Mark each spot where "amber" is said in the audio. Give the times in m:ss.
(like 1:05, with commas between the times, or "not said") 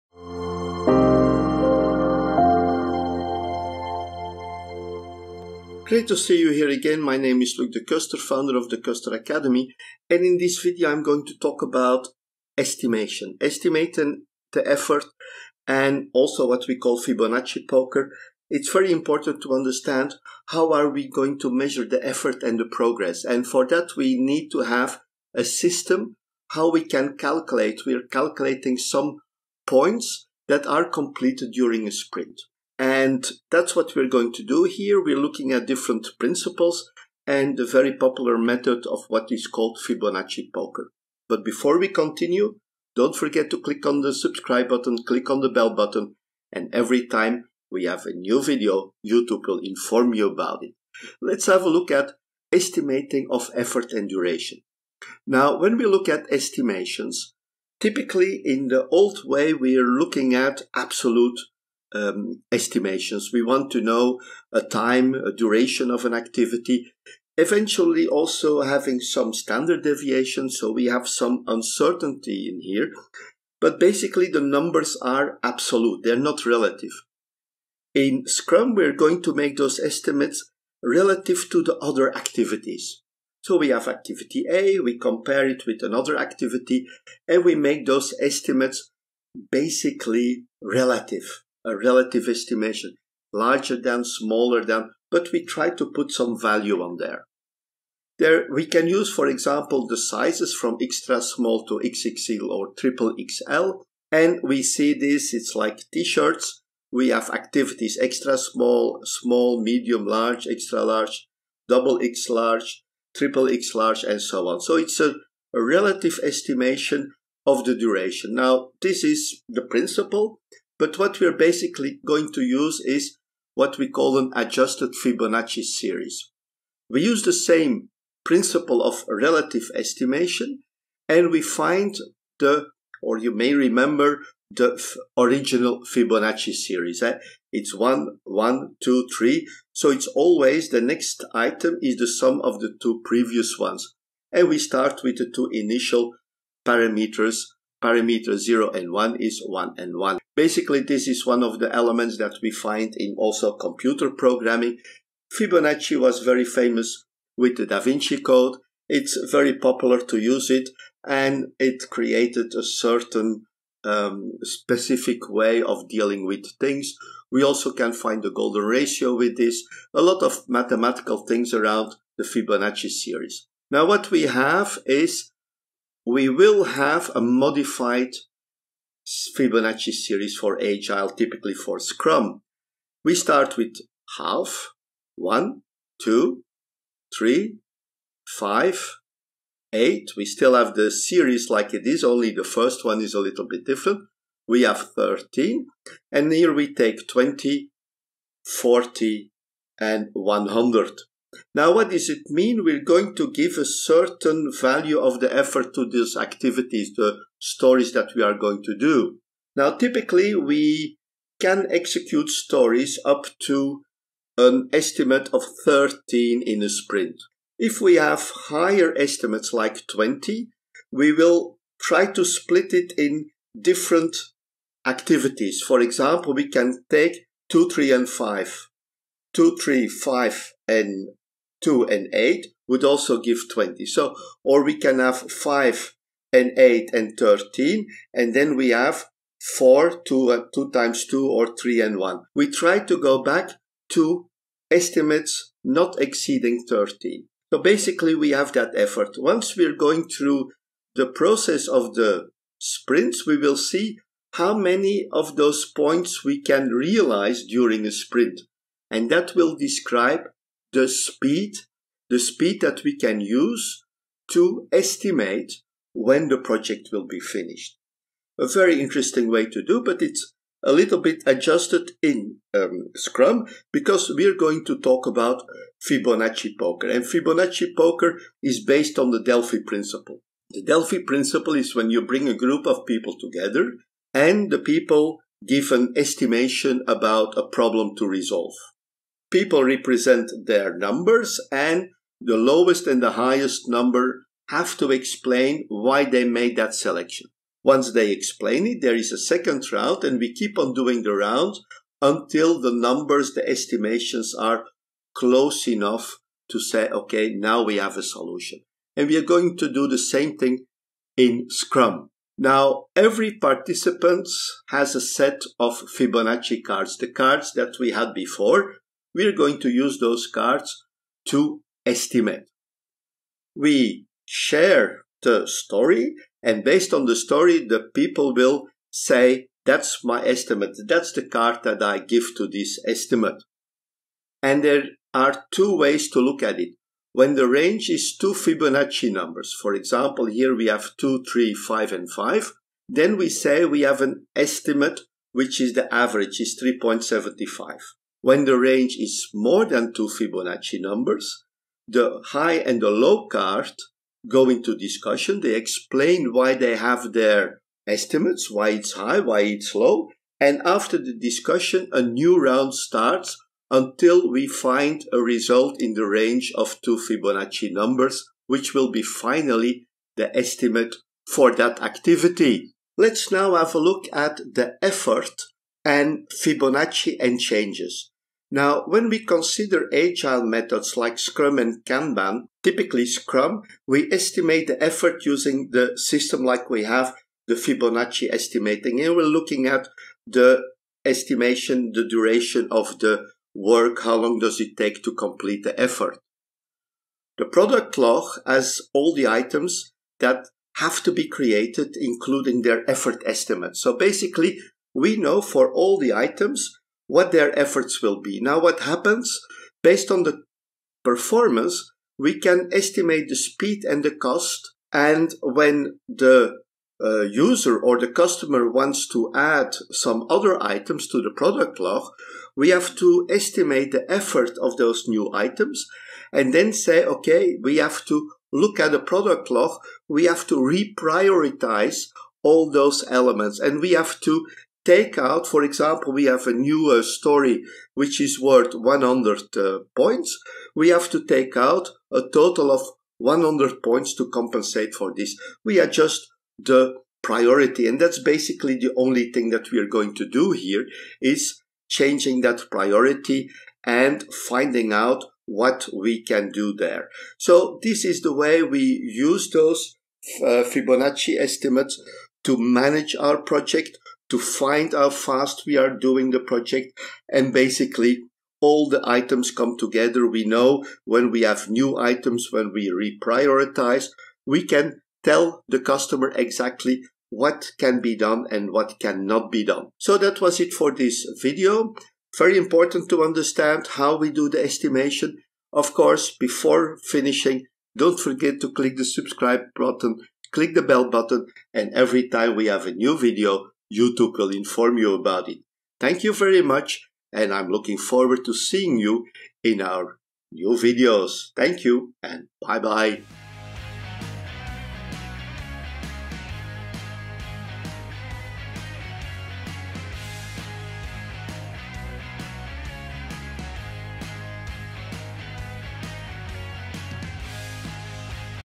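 not said.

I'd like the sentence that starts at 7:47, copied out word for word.
And basically, all the items come together.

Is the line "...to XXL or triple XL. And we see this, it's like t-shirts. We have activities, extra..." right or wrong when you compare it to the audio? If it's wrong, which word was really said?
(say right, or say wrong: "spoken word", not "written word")
right.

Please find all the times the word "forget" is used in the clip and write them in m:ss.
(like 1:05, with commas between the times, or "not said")
0:43, 8:08.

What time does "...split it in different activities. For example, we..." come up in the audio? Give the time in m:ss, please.
3:42.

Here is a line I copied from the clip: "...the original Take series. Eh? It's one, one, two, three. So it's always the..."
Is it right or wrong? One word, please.
wrong.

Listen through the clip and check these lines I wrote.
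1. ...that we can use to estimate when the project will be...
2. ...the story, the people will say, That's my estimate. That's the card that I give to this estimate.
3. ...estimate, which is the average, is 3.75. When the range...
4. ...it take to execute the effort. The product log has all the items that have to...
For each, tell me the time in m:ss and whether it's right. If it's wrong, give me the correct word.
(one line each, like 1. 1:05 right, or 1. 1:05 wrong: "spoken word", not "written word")
1. 4:22 right
2. 5:27 right
3. 5:44 right
4. 6:34 wrong: "complete", not "execute".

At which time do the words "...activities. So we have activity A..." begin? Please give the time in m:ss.
1:22.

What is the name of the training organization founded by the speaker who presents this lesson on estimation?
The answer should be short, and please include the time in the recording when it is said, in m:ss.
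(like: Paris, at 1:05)
De Ceuster Academy, at 0:08.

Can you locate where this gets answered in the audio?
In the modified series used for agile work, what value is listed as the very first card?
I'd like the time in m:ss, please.
3:04.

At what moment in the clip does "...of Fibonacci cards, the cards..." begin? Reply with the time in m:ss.
5:15.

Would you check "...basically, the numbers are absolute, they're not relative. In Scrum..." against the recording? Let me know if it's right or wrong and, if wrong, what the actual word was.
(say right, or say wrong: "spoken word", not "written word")
right.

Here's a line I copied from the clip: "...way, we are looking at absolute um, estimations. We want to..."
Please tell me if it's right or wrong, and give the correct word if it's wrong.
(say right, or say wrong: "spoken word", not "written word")
right.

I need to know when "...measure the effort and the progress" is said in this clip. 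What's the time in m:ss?
0:21.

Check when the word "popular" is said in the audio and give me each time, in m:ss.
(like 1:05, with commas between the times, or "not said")
0:37, 2:39.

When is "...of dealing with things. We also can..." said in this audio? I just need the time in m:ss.
2:45.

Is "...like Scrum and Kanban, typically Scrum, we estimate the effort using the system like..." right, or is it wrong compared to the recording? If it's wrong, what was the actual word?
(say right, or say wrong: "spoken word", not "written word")
right.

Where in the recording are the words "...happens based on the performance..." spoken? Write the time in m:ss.
6:48.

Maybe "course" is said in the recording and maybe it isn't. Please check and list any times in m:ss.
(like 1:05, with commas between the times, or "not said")
8:05.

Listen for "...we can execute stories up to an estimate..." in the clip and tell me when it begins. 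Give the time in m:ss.
3:30.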